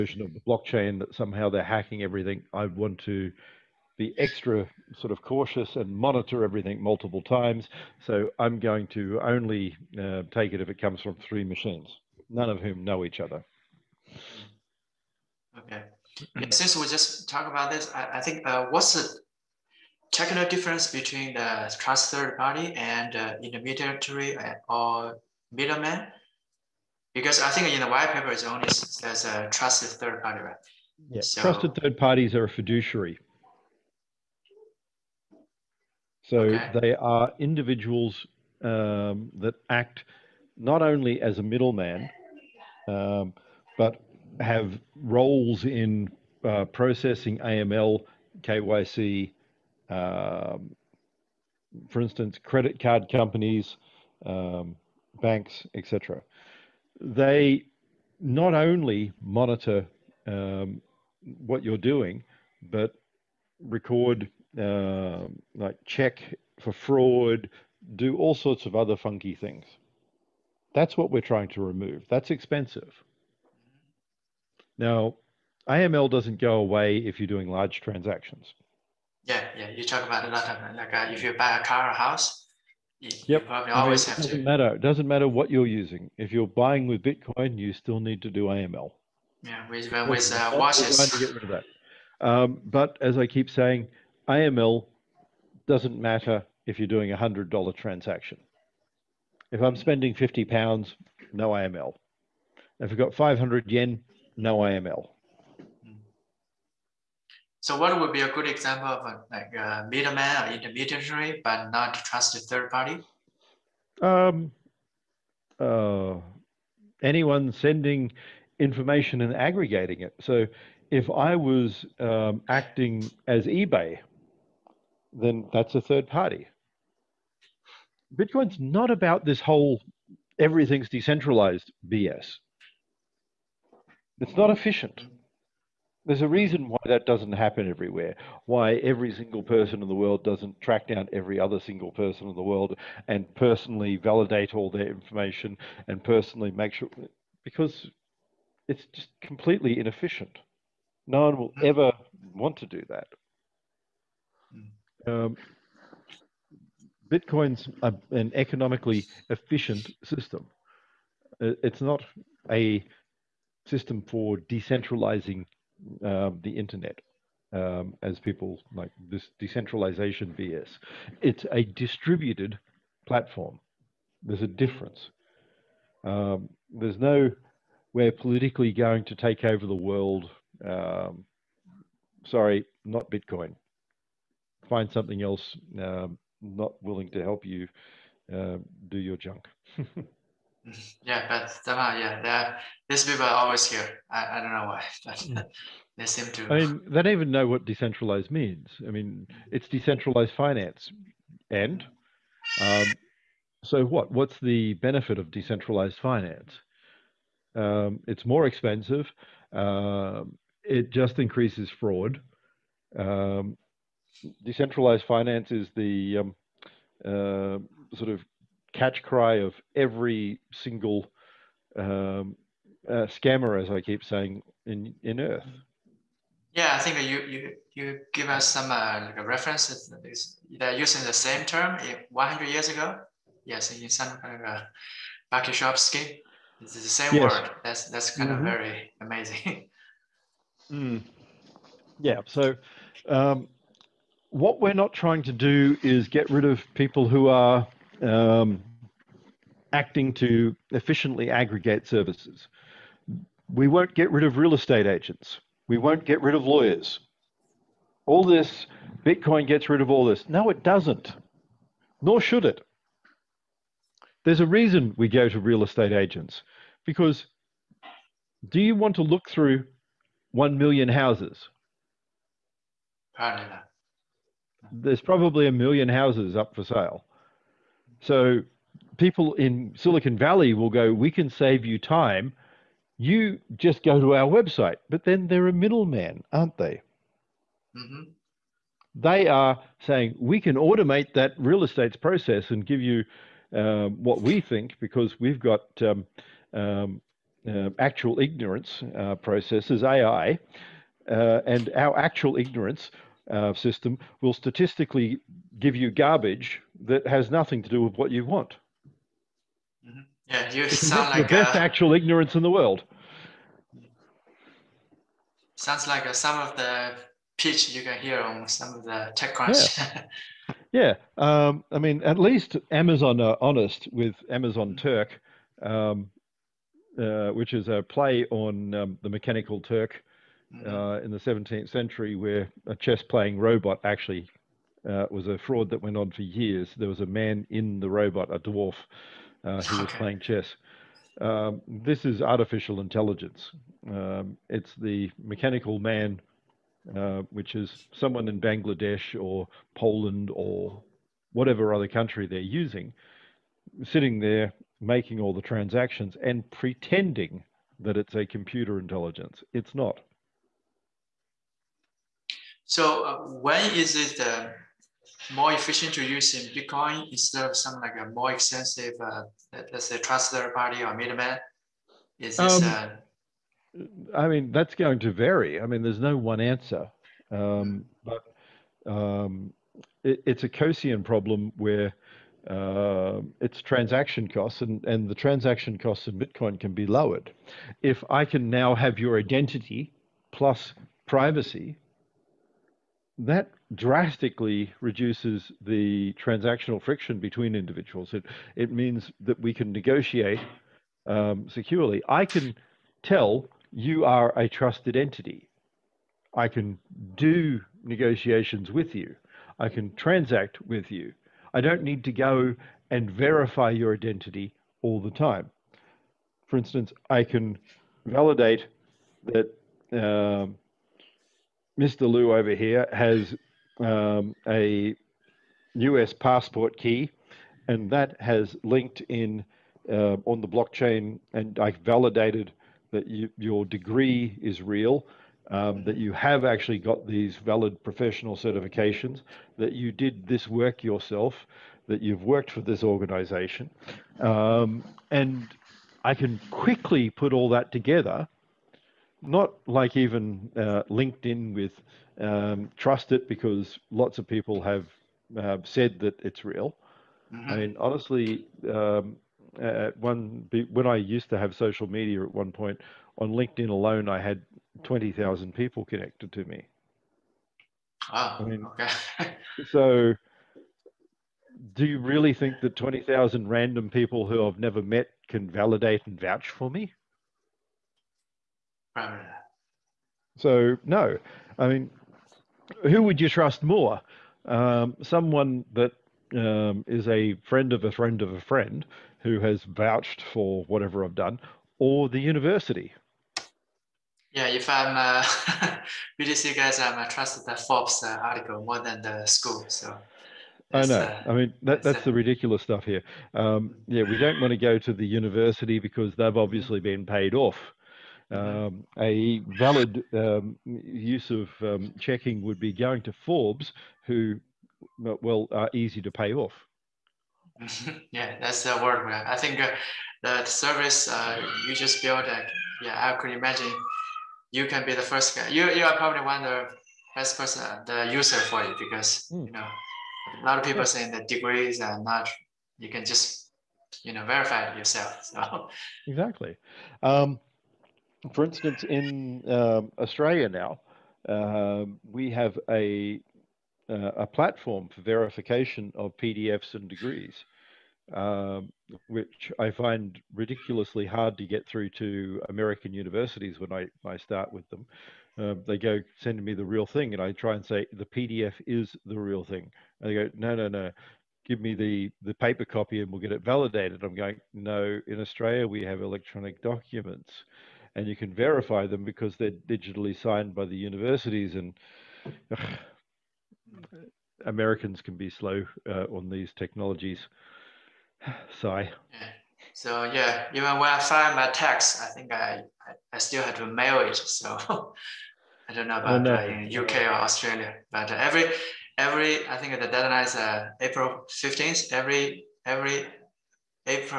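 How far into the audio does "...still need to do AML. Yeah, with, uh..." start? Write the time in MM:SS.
01:27.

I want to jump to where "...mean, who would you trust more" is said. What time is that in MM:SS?
08:01.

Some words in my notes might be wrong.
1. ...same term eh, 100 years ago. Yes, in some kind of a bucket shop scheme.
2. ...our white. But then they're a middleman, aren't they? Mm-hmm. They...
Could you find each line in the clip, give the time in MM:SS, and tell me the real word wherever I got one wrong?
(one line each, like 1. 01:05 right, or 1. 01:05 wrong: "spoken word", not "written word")
1. 03:51 right
2. 04:44 wrong: "website", not "white".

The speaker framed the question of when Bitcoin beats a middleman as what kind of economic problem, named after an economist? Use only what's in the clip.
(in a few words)
Coasian.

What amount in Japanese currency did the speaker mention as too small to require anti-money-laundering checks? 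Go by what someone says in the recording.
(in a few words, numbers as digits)
500 yen.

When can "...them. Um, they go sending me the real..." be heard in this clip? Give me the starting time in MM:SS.
09:14.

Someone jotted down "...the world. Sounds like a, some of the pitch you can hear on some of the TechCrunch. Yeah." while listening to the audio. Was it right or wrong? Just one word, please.
right.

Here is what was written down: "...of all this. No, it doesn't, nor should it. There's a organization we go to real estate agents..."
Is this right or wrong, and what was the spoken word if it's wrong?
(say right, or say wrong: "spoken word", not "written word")
wrong: "reason", not "organization".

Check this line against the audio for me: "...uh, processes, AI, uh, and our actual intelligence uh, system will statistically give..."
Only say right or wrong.
wrong.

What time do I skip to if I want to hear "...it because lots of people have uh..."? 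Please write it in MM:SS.
07:33.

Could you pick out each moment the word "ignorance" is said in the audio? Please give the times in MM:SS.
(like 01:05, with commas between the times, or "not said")
04:58, 05:02, 05:11.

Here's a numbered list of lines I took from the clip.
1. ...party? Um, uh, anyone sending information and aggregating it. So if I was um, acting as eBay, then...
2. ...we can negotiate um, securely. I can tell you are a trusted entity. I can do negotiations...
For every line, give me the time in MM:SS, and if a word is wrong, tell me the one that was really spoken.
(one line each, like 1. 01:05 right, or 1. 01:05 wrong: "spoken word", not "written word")
1. 01:52 right
2. 06:39 right.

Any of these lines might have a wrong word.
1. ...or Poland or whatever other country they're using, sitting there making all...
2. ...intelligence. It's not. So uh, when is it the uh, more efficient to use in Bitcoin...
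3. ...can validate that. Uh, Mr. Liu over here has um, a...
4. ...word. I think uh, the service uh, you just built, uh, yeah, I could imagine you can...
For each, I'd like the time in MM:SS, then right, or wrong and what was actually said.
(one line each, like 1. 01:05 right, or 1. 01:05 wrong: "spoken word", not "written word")
1. 05:49 right
2. 05:58 right
3. 06:57 right
4. 08:38 right.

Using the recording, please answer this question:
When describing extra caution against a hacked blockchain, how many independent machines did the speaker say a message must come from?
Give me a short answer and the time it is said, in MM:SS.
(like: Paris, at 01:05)
3, at 00:11.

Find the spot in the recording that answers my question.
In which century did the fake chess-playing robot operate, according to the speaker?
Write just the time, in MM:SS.
05:31.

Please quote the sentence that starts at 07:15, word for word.
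Um, that you have actually got these valid professional certifications, that you did this work yourself, that you've worked for this organization.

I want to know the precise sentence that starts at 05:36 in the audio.
There was a man in the robot, a dwarf, uh, who was playing chess.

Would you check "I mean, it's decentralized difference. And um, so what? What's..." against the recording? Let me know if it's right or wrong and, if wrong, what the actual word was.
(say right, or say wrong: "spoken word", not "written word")
wrong: "finance", not "difference".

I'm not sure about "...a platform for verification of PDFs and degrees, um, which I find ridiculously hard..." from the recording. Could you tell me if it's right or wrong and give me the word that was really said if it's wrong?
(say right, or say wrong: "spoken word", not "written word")
right.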